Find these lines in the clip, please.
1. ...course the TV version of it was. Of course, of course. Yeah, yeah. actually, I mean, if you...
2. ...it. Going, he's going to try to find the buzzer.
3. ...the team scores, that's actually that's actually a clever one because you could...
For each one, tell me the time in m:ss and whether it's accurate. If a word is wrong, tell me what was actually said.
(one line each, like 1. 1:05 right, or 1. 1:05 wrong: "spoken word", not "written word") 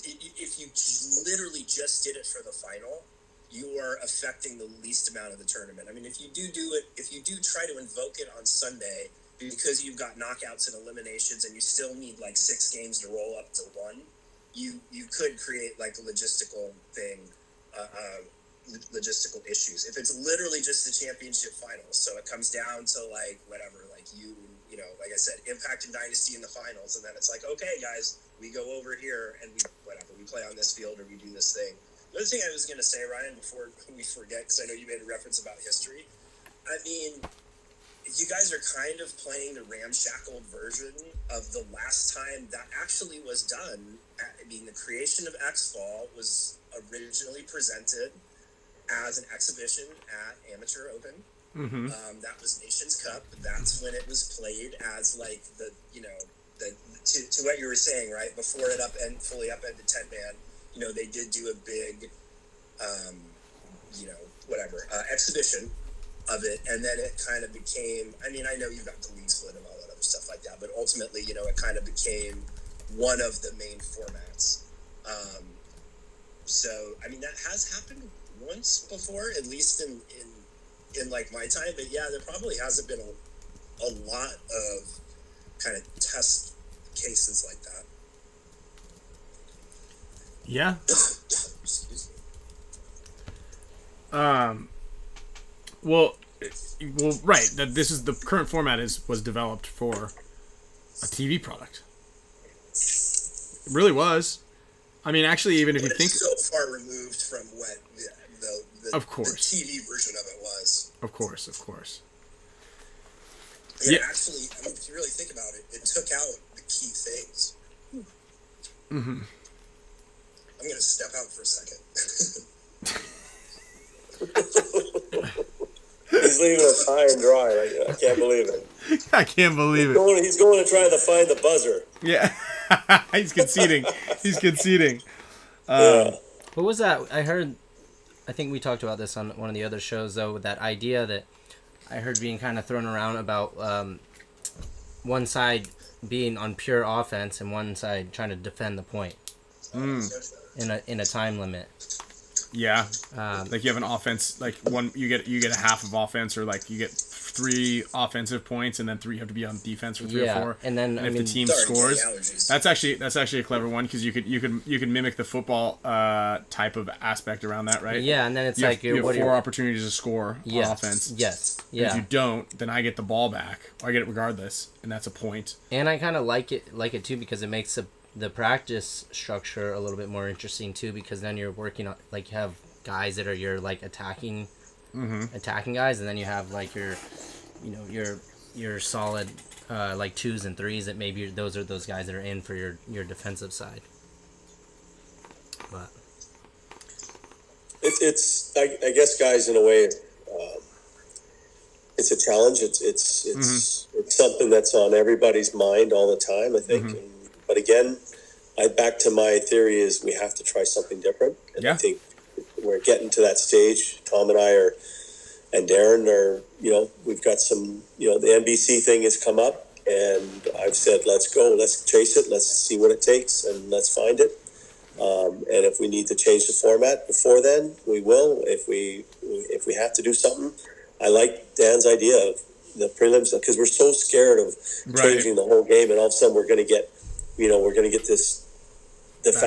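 1. 1:49 right
2. 2:09 right
3. 2:41 right.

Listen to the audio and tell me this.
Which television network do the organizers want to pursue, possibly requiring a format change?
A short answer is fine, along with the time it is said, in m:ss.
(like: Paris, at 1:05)
NBC, at 3:38.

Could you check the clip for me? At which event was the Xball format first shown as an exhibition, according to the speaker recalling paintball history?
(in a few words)
Amateur Open.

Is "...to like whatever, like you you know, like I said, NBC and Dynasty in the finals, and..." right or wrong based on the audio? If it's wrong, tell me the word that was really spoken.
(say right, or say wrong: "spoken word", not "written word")
wrong: "Impact", not "NBC".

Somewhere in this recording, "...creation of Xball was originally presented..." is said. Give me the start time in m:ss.
0:44.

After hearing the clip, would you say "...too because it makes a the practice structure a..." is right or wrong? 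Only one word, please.
right.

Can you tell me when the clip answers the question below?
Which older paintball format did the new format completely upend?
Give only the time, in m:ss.
0:59.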